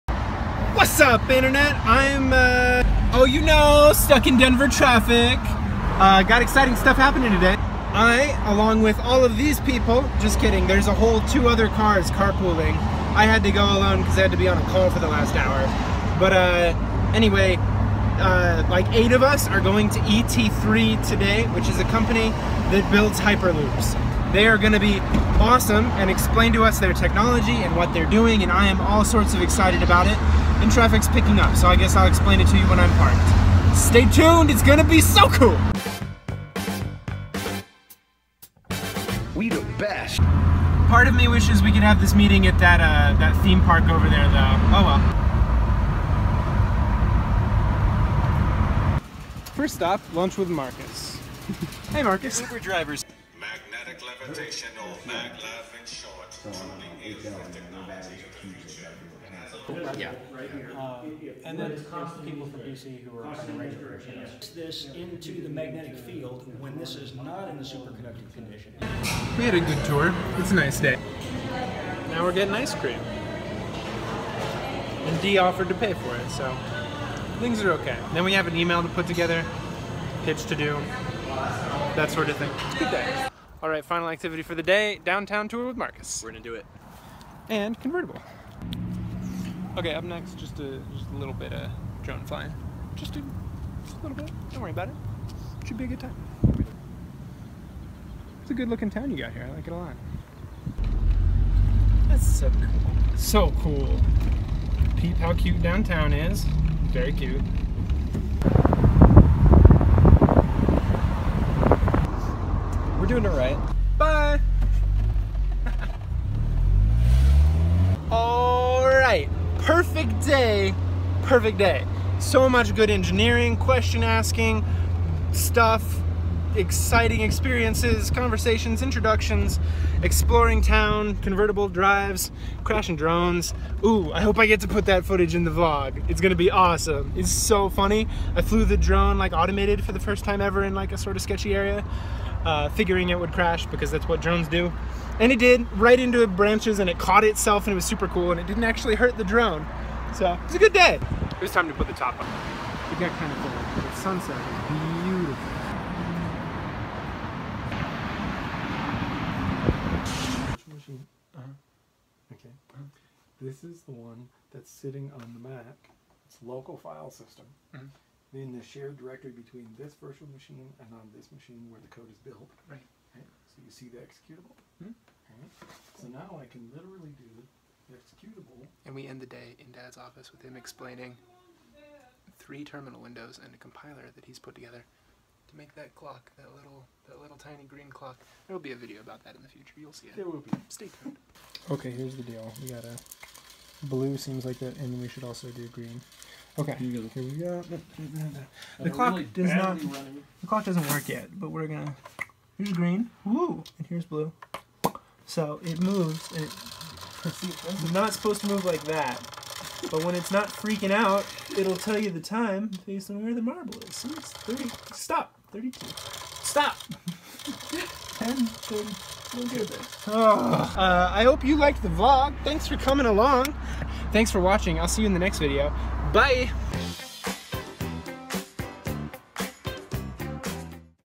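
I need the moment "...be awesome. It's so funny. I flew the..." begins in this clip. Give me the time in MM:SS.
02:16.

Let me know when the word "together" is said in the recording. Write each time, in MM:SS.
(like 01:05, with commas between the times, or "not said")
01:19, 03:04.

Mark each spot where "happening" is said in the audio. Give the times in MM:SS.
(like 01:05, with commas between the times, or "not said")
00:06.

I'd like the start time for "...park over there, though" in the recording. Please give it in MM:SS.
00:43.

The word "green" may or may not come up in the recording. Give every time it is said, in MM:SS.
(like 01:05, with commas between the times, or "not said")
03:07, 03:15, 03:22.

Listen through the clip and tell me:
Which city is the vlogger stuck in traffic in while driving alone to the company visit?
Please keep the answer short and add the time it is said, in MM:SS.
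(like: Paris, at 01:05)
Denver, at 00:04.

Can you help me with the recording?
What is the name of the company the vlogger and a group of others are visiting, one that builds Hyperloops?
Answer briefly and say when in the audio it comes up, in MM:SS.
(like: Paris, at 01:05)
ET3, at 00:19.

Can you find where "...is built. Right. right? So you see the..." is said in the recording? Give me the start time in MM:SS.
02:52.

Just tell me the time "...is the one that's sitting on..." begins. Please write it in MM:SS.
02:43.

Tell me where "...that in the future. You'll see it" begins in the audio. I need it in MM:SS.
03:09.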